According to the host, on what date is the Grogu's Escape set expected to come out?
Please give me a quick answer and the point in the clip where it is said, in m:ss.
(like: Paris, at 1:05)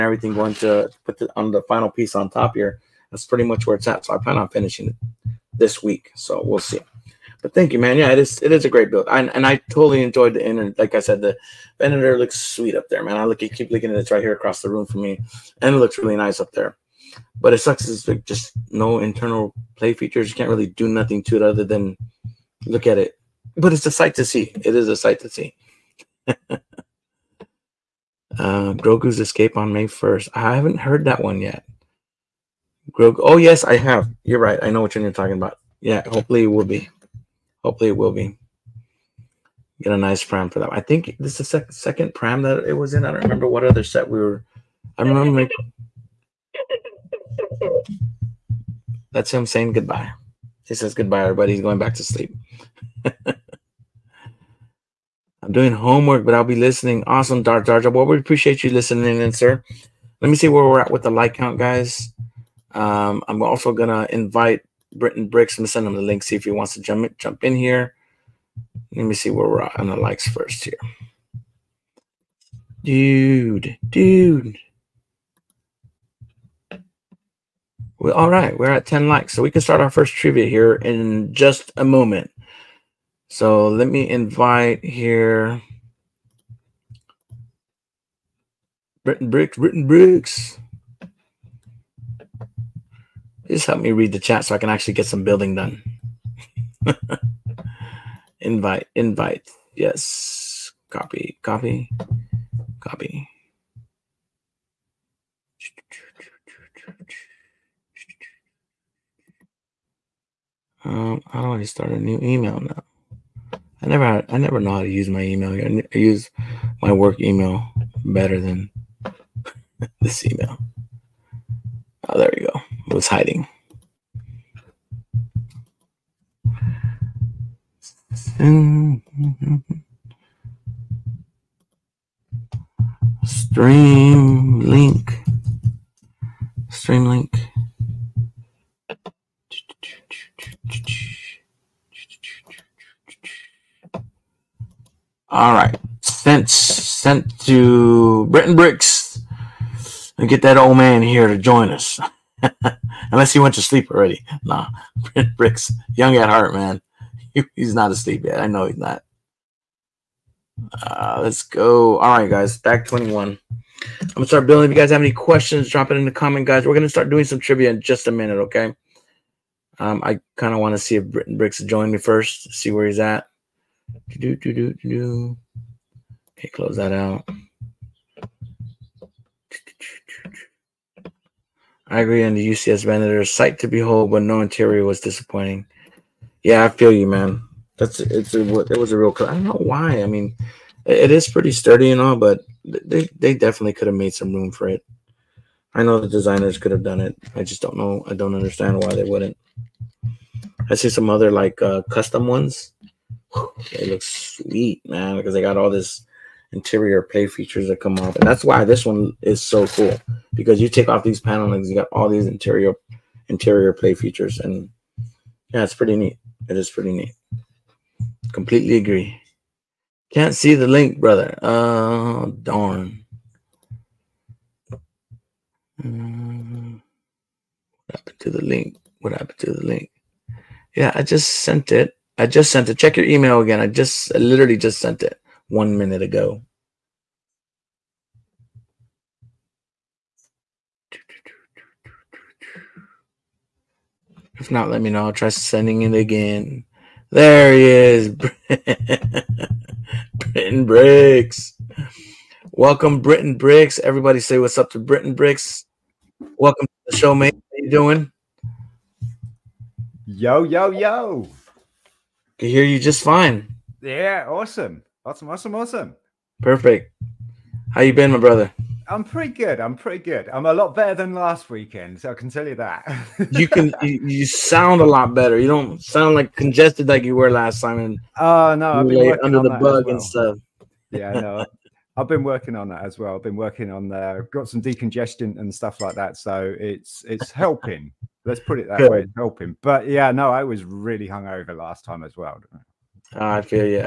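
May 1st, at 0:29.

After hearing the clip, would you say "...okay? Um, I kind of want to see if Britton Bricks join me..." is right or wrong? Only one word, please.
right.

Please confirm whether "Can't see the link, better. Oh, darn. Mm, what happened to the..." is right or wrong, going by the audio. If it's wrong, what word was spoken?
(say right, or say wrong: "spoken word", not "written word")
wrong: "brother", not "better".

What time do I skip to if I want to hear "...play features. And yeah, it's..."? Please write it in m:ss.
3:33.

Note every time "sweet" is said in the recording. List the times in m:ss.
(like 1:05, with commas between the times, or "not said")
0:12, 3:24.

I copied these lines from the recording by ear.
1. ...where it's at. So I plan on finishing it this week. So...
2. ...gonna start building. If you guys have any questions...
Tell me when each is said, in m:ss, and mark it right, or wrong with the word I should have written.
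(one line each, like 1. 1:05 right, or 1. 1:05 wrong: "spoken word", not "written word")
1. 0:03 right
2. 2:44 right.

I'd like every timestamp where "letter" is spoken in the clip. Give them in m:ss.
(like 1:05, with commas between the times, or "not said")
not said.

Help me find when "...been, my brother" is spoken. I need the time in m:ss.
4:27.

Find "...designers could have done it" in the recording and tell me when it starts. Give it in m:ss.
3:16.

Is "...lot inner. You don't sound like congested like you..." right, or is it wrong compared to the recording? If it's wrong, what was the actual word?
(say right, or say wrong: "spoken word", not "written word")
wrong: "better", not "inner".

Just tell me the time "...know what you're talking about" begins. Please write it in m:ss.
0:34.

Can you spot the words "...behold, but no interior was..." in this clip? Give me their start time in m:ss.
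3:03.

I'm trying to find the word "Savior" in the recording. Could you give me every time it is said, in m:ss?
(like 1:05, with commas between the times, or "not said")
not said.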